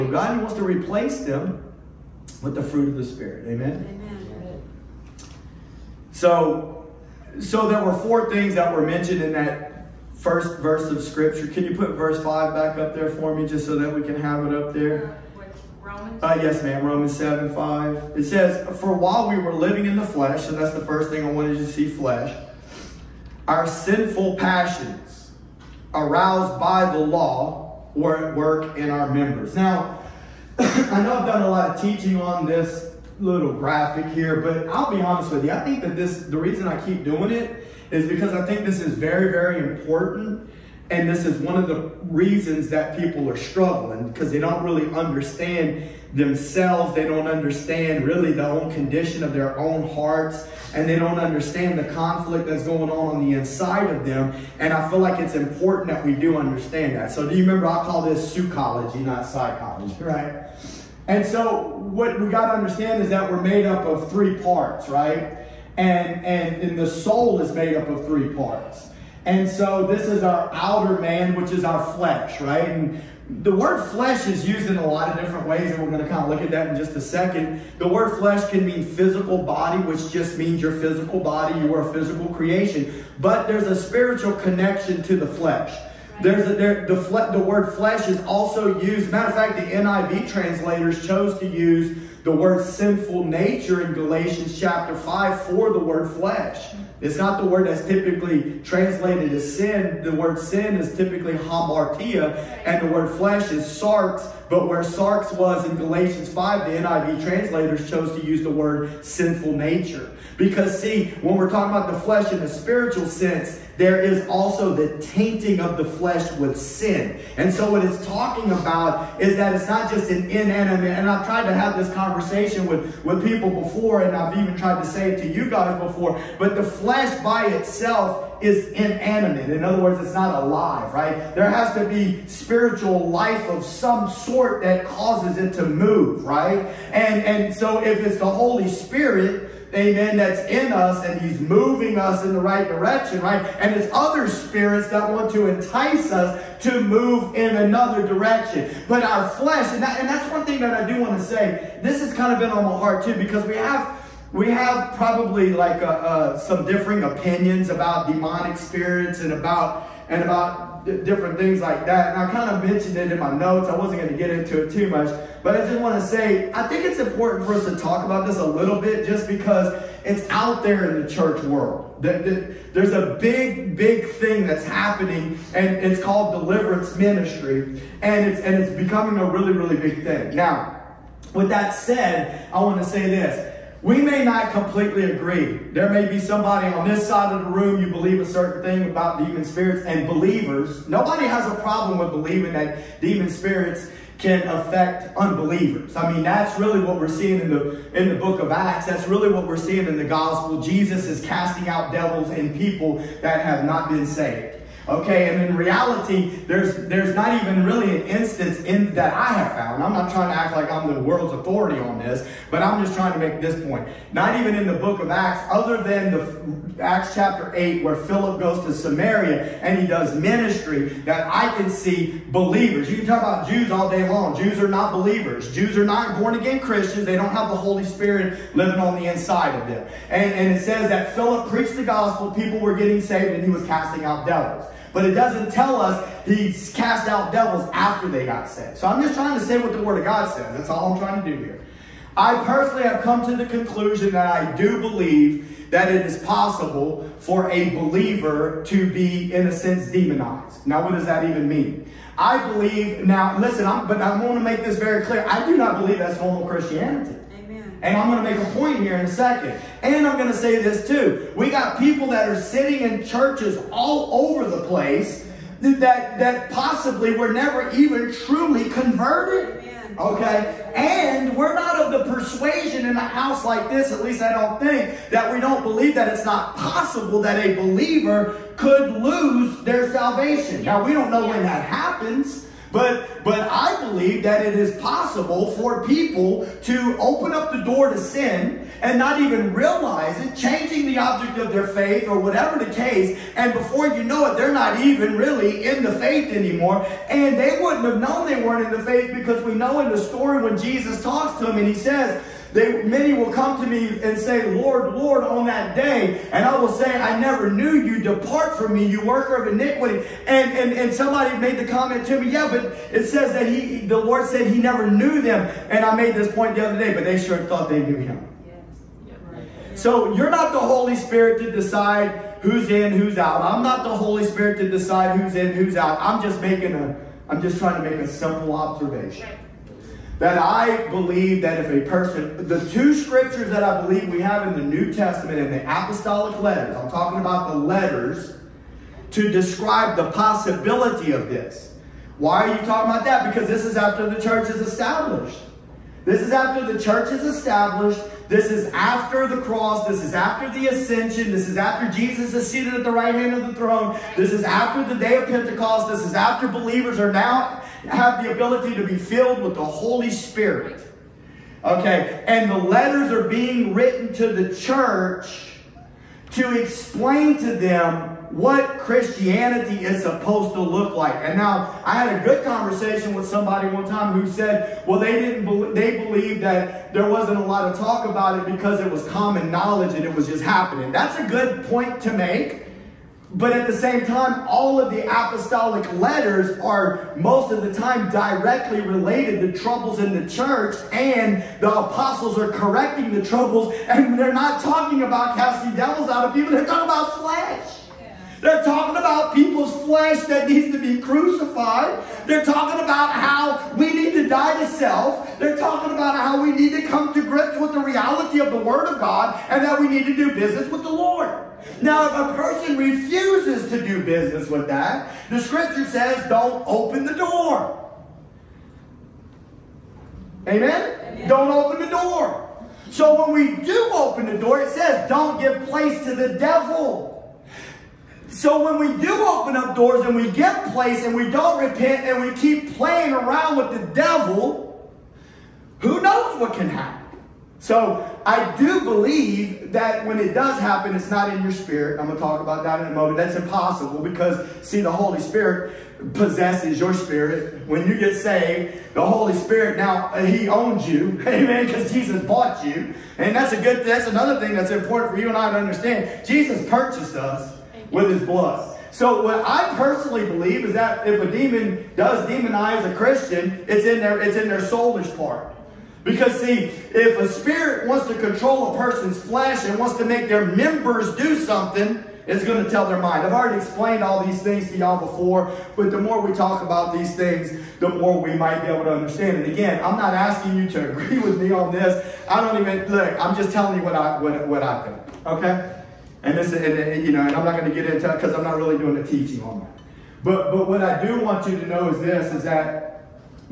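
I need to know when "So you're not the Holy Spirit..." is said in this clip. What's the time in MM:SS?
05:19.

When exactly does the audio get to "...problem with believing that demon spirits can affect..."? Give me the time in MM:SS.
03:11.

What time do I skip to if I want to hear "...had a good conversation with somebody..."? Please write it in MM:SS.
06:12.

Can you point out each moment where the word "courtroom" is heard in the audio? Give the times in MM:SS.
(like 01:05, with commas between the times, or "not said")
not said.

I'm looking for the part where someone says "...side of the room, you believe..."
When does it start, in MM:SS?
03:07.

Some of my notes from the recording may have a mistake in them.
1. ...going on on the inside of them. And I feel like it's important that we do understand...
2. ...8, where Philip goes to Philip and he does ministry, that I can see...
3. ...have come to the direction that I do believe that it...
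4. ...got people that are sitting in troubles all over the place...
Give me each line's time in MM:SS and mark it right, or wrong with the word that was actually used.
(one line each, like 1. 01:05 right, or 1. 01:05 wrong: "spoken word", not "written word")
1. 00:52 right
2. 03:37 wrong: "Samaria", not "Philip"
3. 04:02 wrong: "conclusion", not "direction"
4. 04:21 wrong: "churches", not "troubles".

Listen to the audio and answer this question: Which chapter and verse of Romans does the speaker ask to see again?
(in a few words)
Romans 7:5.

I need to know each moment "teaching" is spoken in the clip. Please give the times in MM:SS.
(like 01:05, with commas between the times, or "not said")
00:31, 08:09.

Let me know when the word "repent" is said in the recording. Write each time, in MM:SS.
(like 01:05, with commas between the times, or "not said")
07:11.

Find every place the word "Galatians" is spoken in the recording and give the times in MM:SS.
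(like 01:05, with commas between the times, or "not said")
01:33, 01:45.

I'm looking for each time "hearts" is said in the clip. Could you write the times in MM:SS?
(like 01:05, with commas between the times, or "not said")
00:49, 02:32.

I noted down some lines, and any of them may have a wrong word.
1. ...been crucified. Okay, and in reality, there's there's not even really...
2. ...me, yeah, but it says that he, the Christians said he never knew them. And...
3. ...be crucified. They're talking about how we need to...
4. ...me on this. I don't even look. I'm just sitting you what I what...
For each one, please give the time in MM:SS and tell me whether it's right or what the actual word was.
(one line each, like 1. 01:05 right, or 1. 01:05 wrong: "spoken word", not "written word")
1. 03:23 wrong: "saved", not "crucified"
2. 05:12 wrong: "Lord", not "Christians"
3. 06:40 right
4. 08:01 wrong: "telling", not "sitting".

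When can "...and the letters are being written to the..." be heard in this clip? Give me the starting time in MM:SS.
06:02.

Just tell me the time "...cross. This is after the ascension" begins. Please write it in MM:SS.
05:49.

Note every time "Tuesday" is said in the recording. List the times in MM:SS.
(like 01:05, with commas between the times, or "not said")
not said.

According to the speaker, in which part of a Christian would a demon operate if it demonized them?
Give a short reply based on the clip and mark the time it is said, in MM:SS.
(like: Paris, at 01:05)
soulish part, at 07:44.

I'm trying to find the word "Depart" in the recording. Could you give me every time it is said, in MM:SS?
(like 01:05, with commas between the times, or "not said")
05:08.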